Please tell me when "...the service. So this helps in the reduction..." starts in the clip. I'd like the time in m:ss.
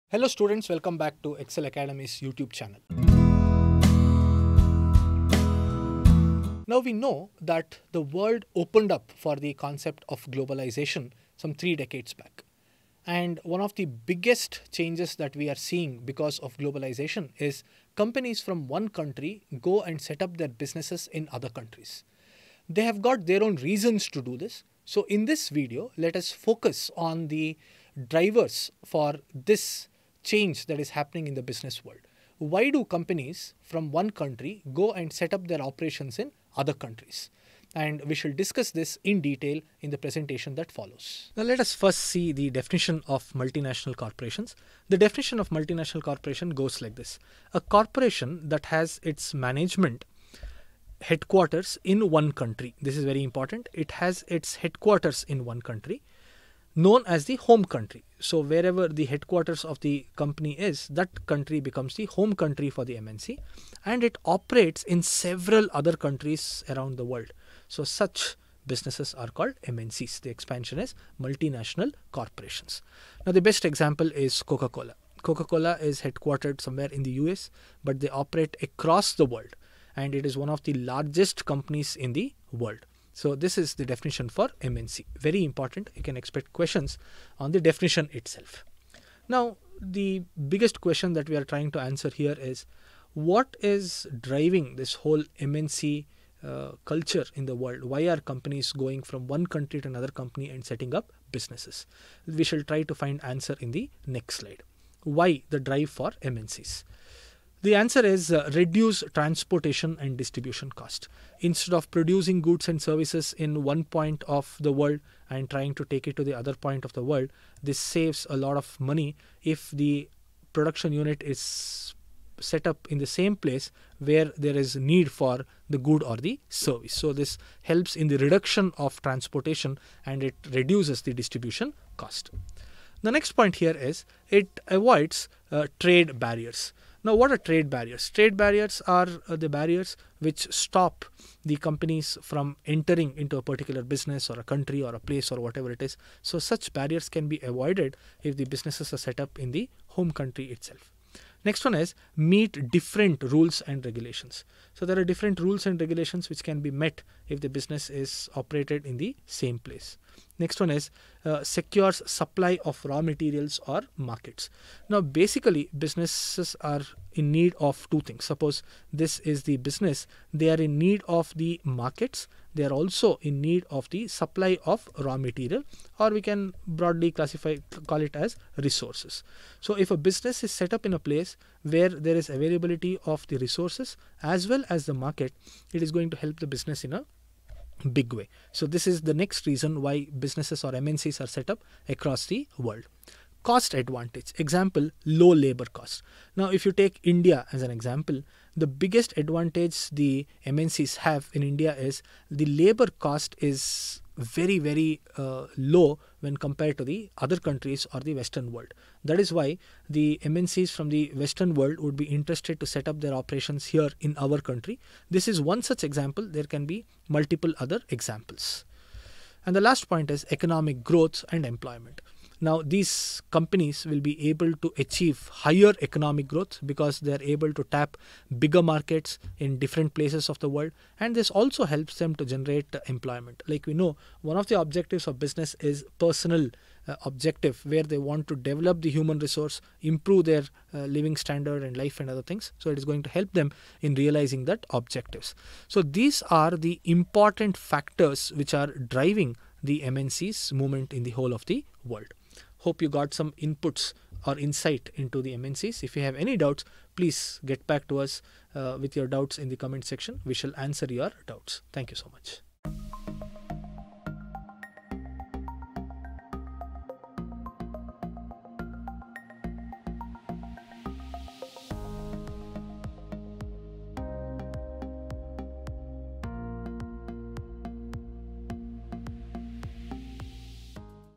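2:06.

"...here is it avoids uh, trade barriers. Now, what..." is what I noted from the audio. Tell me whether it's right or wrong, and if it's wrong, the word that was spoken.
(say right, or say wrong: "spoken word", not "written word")
right.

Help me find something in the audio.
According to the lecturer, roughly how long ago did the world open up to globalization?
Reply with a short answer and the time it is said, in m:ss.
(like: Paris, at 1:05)
3 decades, at 0:11.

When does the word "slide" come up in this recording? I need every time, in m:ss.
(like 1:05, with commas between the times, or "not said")
1:44.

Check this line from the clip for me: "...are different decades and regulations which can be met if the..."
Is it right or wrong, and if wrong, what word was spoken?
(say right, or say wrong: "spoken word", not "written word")
wrong: "rules", not "decades".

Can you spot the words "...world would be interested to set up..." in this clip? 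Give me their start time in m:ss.
3:31.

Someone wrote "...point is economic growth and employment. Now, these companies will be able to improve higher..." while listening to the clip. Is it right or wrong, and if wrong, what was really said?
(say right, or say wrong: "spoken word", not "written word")
wrong: "achieve", not "improve".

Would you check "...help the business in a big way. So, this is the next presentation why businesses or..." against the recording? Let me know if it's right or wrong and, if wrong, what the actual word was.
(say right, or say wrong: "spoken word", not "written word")
wrong: "reason", not "presentation".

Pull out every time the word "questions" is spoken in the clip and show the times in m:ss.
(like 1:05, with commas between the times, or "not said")
1:26, 1:30.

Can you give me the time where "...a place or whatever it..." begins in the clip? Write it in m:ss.
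2:24.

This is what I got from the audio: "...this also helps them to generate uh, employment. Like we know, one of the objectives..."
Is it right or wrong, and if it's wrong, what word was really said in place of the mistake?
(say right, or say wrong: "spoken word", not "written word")
right.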